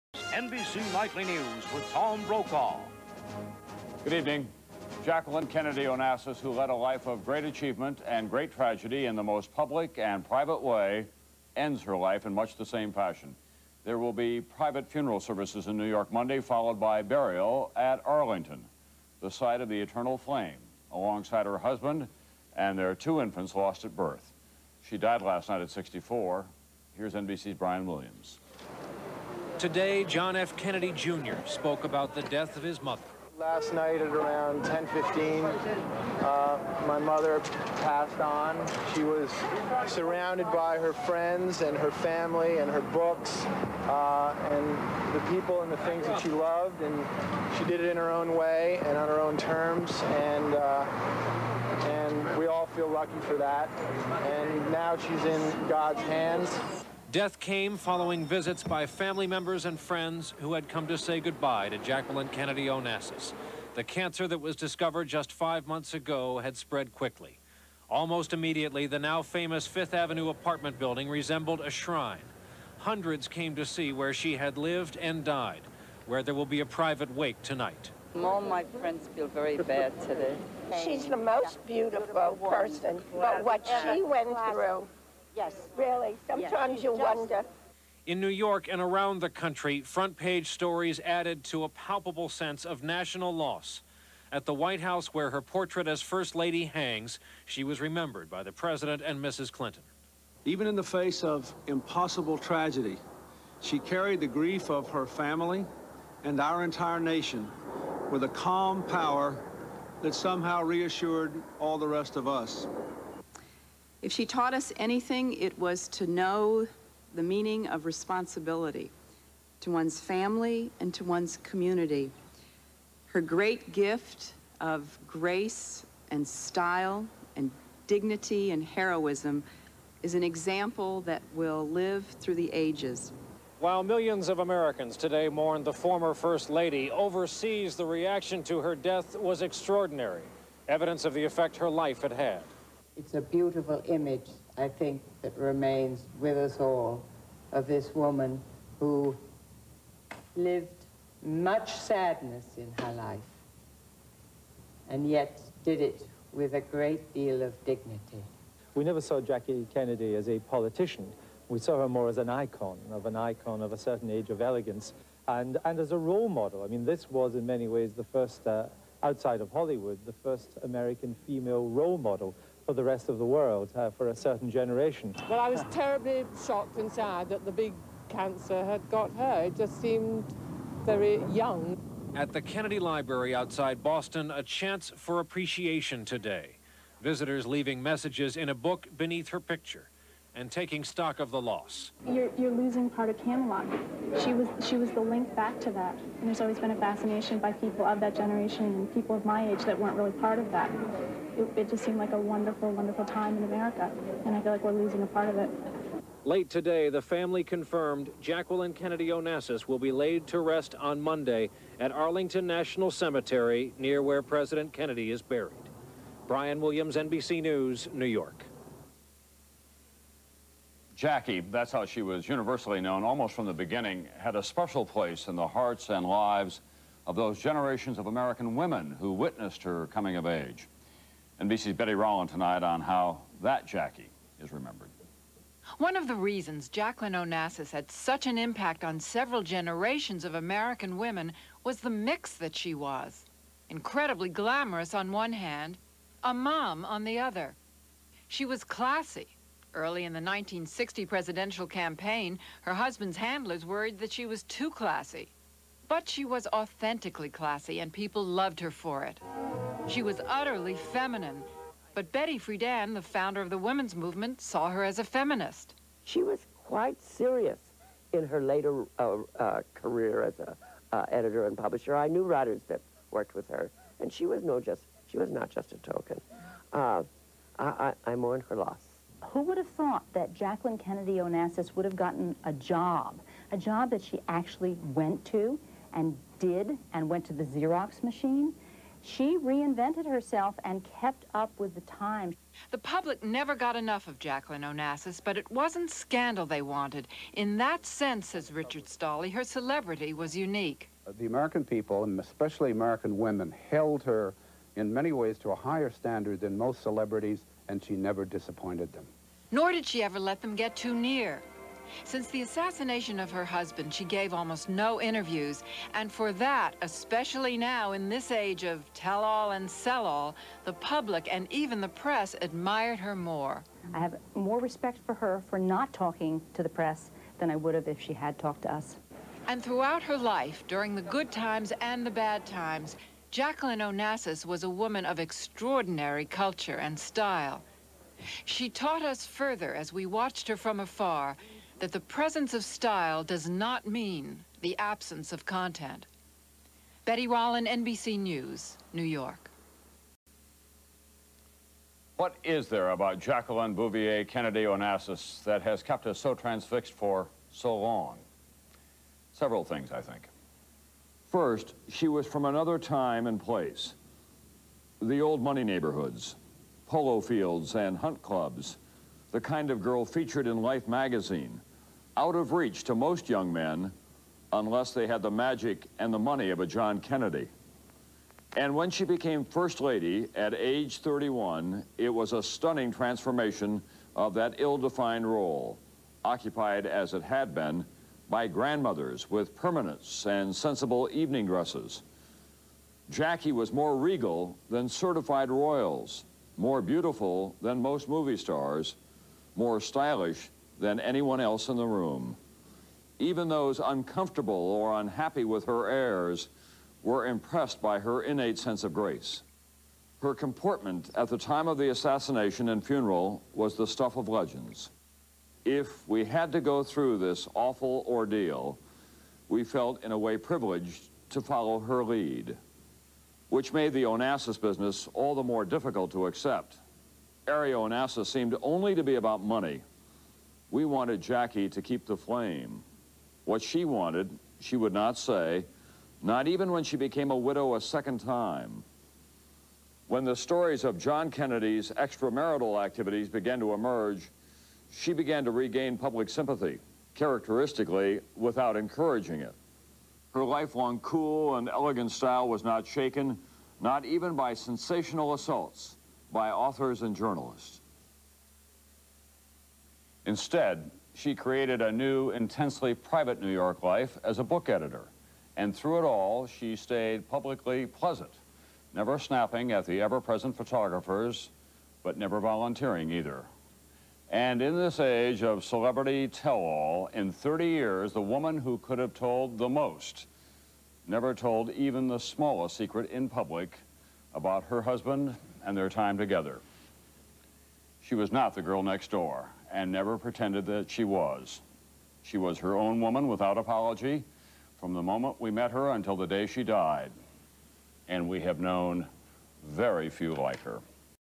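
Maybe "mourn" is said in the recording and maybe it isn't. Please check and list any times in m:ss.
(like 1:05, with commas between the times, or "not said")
2:15, 4:38.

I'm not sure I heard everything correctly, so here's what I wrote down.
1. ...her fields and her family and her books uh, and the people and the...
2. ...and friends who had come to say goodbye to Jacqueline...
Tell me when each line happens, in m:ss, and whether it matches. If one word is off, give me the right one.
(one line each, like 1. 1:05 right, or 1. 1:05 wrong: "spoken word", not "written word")
1. 0:40 wrong: "friends", not "fields"
2. 0:59 right.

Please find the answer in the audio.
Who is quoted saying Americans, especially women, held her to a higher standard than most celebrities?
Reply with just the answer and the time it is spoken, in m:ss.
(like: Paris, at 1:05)
Richard Stolley, at 4:58.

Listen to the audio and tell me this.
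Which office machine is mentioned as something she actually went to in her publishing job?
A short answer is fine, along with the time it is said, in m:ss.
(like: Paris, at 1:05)
Xerox machine, at 4:47.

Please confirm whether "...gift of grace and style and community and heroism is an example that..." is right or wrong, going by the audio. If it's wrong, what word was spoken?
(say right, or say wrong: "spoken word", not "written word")
wrong: "dignity", not "community".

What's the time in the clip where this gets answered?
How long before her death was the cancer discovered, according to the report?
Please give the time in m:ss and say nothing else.
1:05.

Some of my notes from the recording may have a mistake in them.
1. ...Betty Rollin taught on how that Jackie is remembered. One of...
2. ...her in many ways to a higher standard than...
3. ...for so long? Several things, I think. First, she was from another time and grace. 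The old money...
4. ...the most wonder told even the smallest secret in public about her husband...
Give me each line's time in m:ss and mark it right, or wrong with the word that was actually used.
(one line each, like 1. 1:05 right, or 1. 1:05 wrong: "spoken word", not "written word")
1. 3:51 wrong: "tonight", not "taught"
2. 5:04 right
3. 5:56 wrong: "place", not "grace"
4. 7:59 wrong: "never", not "wonder".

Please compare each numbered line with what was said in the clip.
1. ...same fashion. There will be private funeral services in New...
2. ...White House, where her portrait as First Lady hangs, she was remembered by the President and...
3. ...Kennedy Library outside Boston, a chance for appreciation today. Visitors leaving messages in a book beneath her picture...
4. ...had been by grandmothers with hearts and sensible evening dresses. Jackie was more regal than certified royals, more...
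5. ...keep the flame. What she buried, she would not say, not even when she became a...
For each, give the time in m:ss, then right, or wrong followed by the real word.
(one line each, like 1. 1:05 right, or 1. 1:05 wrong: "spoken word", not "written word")
1. 0:12 right
2. 1:34 right
3. 3:02 right
4. 6:27 wrong: "permanents", not "hearts"
5. 7:11 wrong: "wanted", not "buried".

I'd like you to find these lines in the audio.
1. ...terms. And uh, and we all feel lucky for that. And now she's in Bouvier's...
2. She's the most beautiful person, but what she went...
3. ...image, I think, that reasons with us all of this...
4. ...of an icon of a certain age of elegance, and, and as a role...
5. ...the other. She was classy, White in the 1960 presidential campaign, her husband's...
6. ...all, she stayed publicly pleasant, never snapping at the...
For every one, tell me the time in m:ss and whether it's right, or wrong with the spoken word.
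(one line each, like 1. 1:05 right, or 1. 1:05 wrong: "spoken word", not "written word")
1. 0:49 wrong: "God", not "Bouvier"
2. 1:20 right
3. 2:23 wrong: "remains", not "reasons"
4. 2:42 right
5. 4:07 wrong: "Early", not "White"
6. 7:46 right.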